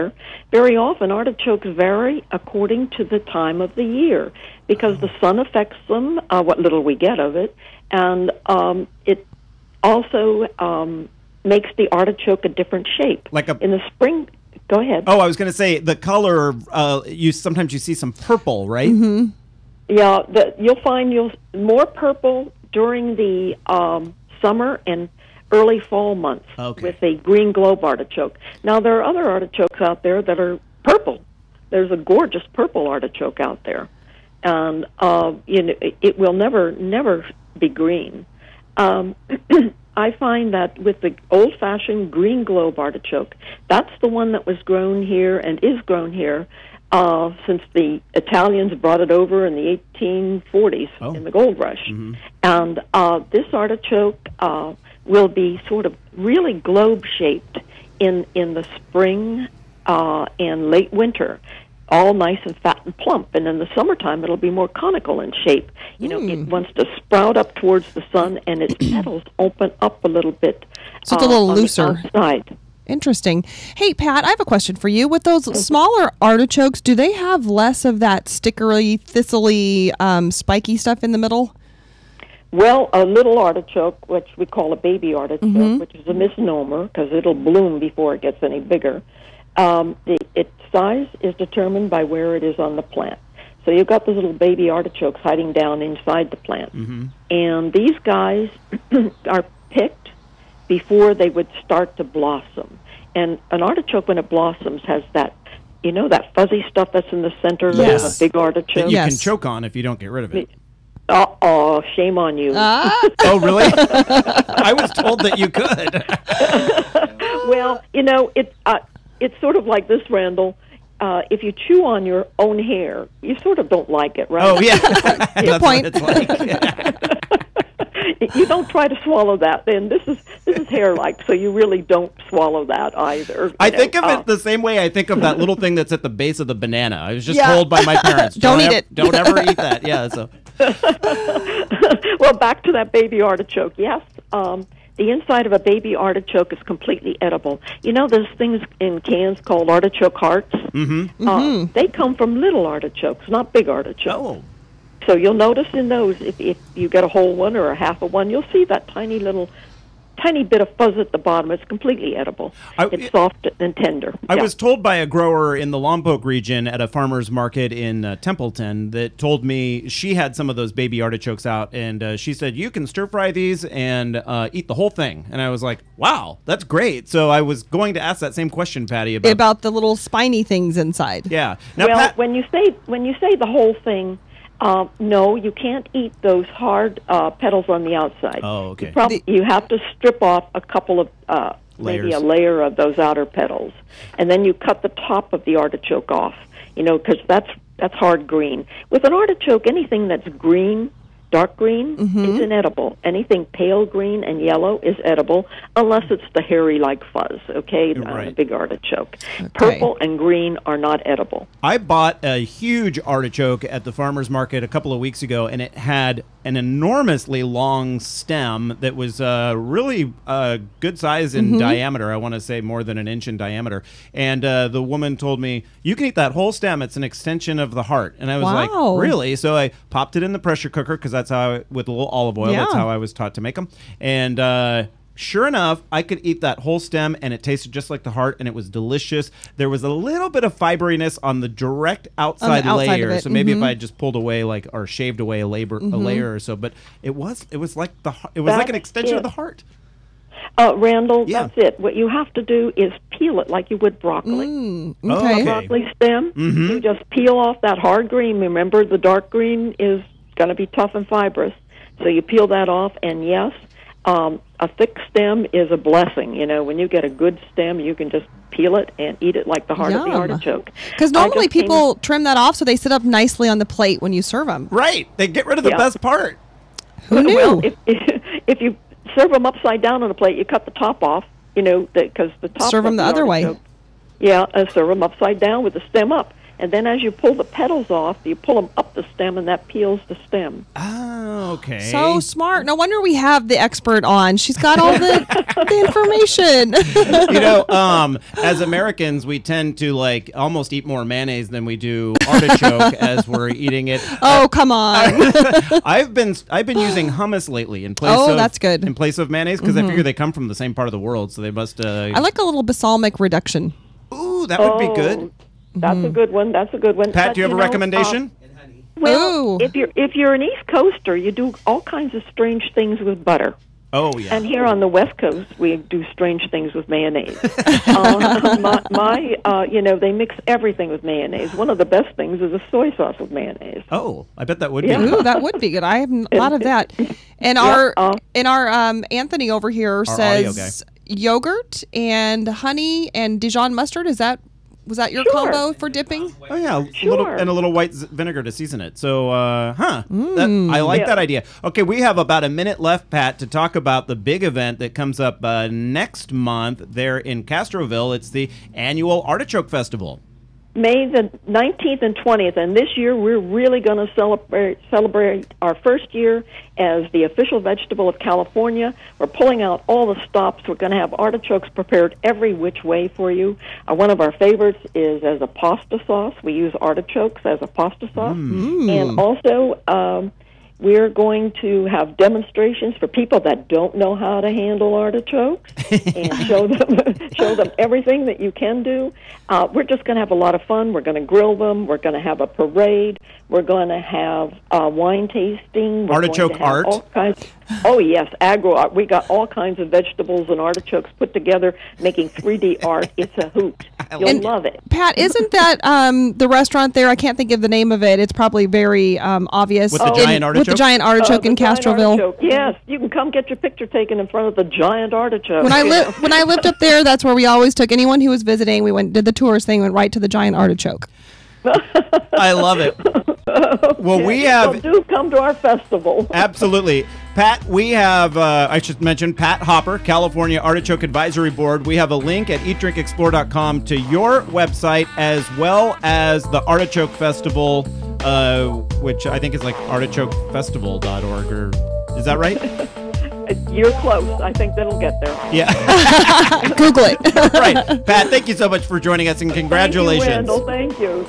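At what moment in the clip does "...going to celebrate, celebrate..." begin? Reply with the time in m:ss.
6:03.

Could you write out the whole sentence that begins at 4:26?
You know, when you get a good stem, you can just peel it and eat it like the heart Yum.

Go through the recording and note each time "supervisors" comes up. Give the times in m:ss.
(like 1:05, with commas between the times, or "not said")
not said.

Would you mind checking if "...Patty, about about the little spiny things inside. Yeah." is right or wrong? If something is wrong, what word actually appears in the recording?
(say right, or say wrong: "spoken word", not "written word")
right.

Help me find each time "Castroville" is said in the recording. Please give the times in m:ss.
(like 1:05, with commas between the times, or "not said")
5:57, 6:51.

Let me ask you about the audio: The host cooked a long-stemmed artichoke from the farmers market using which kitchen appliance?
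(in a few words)
pressure cooker.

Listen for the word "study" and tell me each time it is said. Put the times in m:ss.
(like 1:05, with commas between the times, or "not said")
not said.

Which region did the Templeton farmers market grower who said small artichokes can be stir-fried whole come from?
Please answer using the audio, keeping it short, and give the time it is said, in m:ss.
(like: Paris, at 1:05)
Lompoc, at 2:45.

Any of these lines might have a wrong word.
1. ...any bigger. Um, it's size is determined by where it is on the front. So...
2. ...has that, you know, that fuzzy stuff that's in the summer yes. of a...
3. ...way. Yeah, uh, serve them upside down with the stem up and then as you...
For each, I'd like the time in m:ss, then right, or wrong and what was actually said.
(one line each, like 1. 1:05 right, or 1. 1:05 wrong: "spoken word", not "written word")
1. 1:28 wrong: "plant", not "front"
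2. 1:44 wrong: "center", not "summer"
3. 4:43 right.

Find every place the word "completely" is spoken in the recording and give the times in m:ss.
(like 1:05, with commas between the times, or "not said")
2:26, 2:41.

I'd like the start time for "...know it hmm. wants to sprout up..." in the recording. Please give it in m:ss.
1:06.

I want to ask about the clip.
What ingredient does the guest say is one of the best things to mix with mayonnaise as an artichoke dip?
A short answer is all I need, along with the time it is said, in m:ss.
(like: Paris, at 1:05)
soy sauce, at 5:32.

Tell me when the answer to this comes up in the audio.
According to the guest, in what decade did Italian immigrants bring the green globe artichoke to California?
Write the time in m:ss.
0:49.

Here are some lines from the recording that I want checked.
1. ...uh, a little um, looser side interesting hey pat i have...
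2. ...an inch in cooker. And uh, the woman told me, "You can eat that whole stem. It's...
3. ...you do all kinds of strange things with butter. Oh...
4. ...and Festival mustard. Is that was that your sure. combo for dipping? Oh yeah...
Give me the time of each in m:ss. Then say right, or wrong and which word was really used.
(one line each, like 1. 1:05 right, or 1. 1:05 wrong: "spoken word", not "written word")
1. 1:11 right
2. 3:42 wrong: "diameter", not "cooker"
3. 5:21 right
4. 5:43 wrong: "Dijon", not "Festival".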